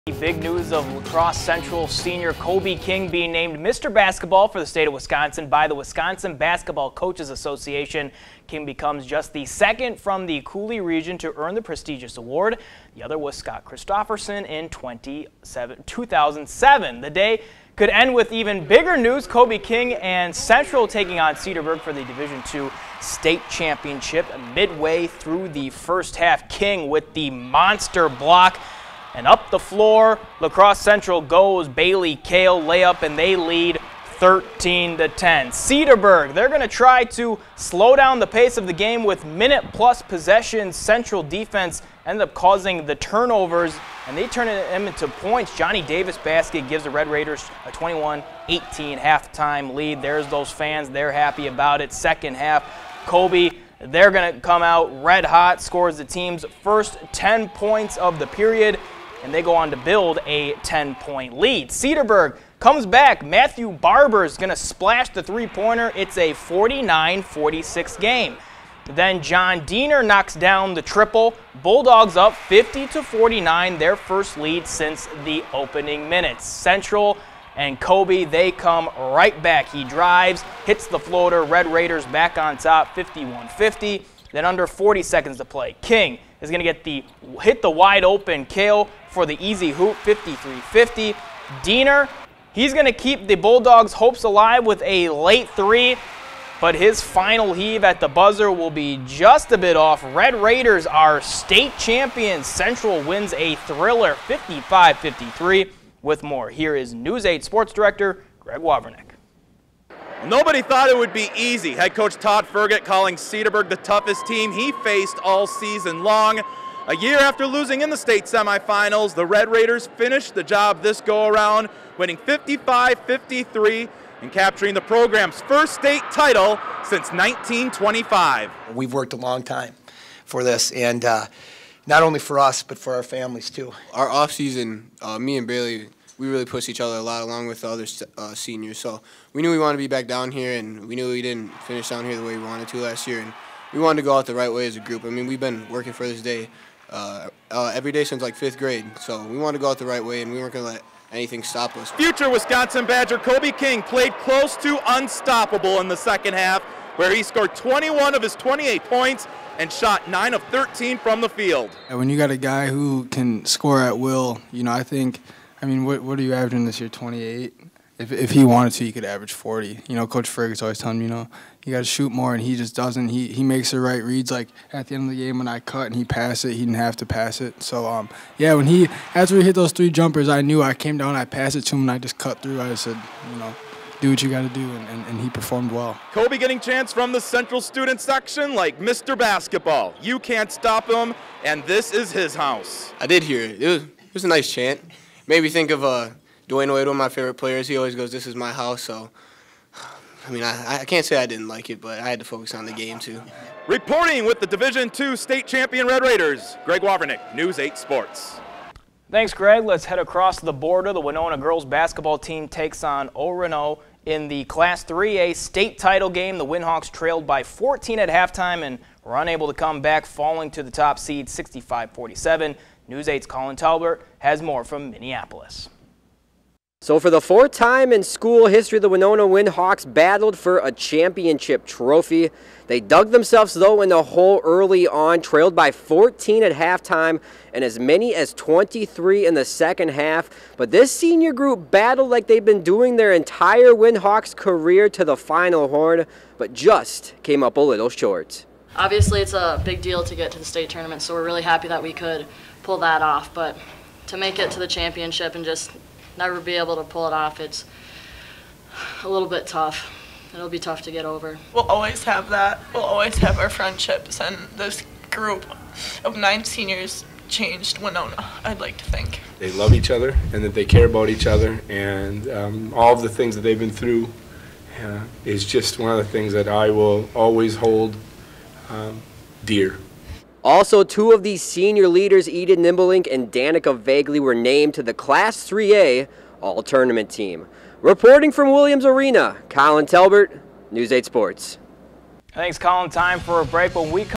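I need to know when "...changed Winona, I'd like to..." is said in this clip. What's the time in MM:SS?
04:27.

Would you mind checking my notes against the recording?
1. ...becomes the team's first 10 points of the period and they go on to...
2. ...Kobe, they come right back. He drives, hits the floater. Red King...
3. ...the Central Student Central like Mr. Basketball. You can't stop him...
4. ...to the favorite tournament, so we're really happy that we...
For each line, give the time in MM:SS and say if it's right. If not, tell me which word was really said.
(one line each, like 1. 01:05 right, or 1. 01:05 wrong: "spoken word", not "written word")
1. 00:55 wrong: "scores", not "becomes"
2. 01:17 wrong: "Raiders", not "King"
3. 03:07 wrong: "Section", not "Central"
4. 04:10 wrong: "state", not "favorite".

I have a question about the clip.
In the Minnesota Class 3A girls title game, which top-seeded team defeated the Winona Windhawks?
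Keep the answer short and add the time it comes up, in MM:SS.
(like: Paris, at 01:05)
Orono, at 03:33.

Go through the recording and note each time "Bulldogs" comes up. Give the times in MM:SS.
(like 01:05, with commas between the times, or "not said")
01:11, 01:33.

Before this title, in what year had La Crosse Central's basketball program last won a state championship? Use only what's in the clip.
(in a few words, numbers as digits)
1925.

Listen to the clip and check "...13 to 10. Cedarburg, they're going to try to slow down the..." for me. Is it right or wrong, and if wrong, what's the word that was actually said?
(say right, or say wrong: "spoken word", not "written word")
right.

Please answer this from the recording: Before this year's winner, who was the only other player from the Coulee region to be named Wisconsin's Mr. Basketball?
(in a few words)
Scott Christofferson.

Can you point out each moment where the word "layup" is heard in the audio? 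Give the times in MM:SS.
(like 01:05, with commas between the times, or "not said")
00:32.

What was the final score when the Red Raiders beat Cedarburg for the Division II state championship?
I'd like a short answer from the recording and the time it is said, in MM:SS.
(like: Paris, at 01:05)
55-53, at 01:44.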